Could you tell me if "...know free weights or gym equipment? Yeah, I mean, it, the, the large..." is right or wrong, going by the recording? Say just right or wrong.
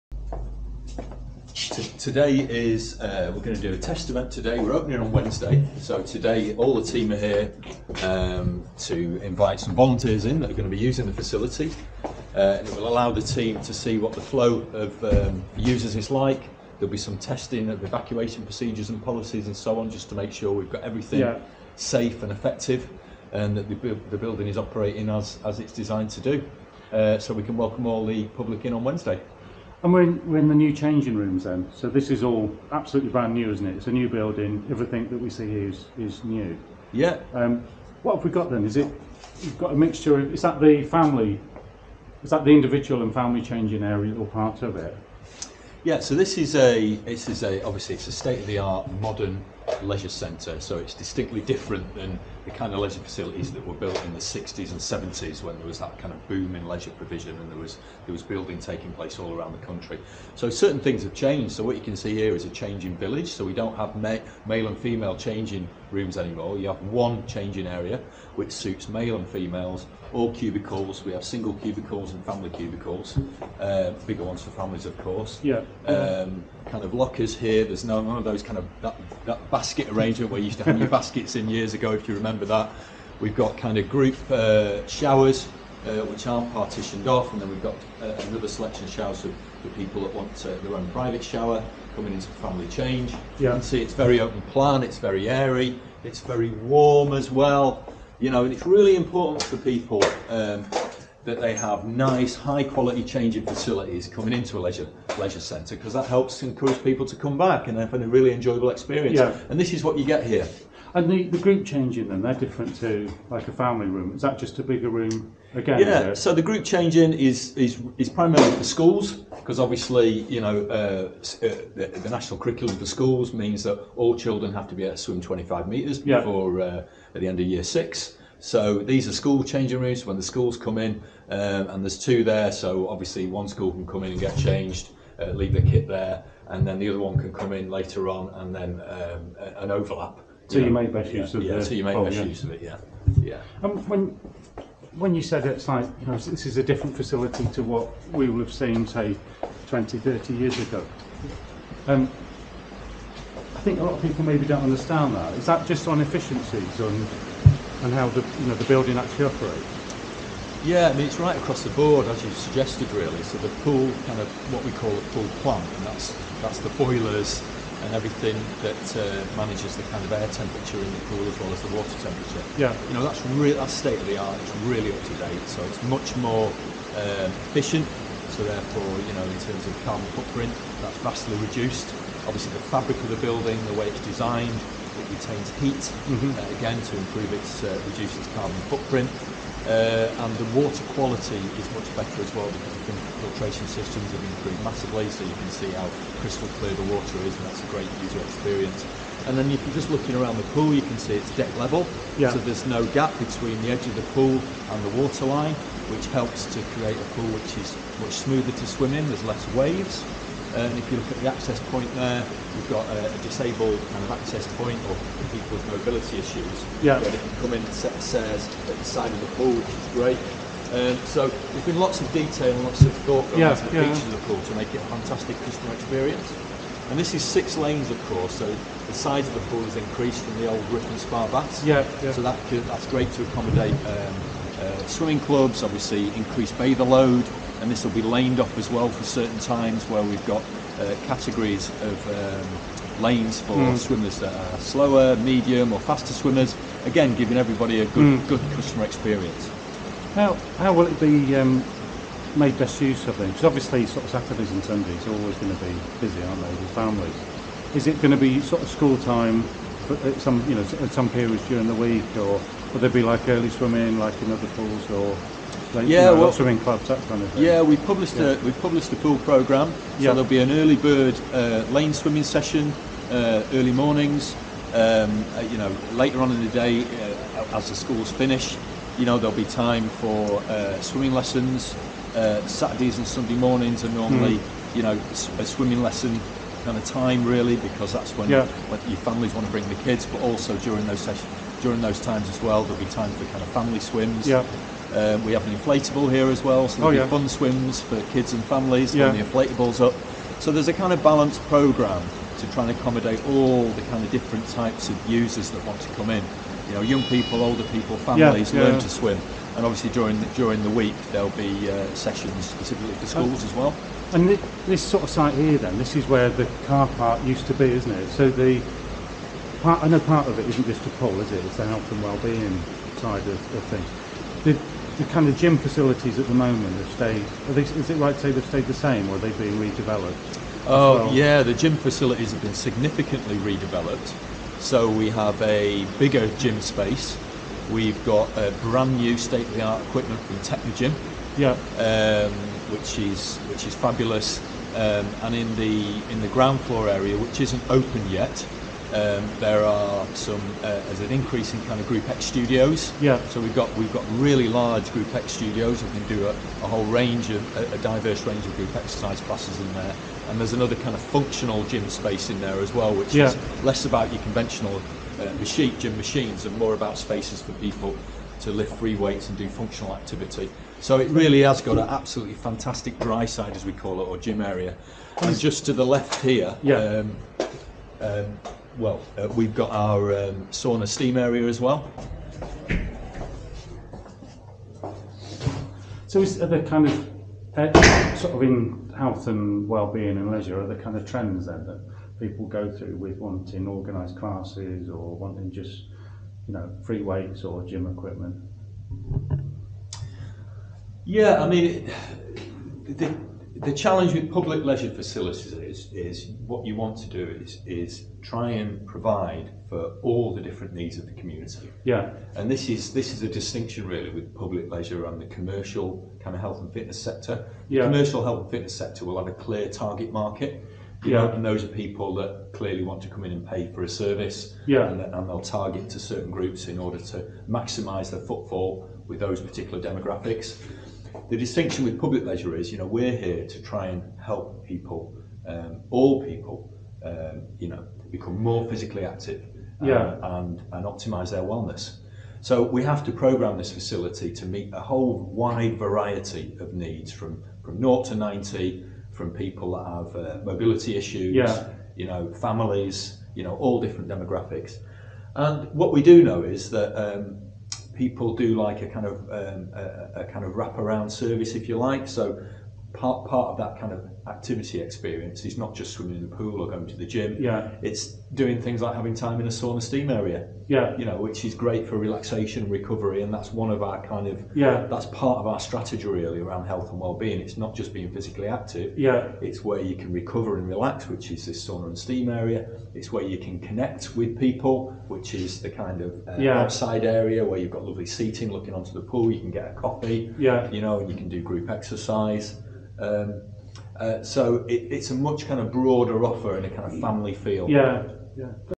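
wrong.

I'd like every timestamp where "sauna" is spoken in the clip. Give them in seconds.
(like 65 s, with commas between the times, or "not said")
380 s, 469 s, 481 s.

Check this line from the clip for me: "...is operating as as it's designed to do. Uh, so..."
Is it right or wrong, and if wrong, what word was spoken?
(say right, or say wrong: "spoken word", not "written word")
right.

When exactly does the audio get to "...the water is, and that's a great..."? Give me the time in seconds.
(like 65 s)
196 s.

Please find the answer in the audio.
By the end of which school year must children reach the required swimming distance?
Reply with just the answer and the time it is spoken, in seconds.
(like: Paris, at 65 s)
year six, at 127 s.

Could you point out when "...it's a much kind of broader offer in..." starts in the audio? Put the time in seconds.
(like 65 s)
494 s.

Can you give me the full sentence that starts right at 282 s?
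Saturdays and Sunday mornings are normally, mm.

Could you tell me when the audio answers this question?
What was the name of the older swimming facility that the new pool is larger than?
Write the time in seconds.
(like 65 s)
230 s.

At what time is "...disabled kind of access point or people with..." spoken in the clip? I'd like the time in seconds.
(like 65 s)
213 s.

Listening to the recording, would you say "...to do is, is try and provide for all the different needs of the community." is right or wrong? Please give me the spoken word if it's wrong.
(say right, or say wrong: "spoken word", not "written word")
right.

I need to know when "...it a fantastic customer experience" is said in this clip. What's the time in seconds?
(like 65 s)
224 s.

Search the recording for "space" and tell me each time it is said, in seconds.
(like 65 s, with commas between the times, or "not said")
336 s, 361 s, 366 s.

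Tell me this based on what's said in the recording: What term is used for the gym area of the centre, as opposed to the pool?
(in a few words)
dry side.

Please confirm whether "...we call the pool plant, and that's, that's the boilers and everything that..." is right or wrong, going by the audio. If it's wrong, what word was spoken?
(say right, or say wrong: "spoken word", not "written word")
right.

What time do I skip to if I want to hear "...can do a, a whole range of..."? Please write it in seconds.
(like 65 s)
355 s.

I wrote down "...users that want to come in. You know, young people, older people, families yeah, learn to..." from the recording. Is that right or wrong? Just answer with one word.
right.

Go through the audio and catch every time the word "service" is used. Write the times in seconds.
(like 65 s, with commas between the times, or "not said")
423 s, 461 s.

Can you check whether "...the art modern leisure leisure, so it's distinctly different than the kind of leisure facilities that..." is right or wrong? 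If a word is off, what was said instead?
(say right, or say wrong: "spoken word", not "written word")
wrong: "centre", not "leisure".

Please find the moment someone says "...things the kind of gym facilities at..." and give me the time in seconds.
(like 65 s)
323 s.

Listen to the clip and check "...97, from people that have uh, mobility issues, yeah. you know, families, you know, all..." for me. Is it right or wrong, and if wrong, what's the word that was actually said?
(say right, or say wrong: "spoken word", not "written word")
wrong: "90", not "97".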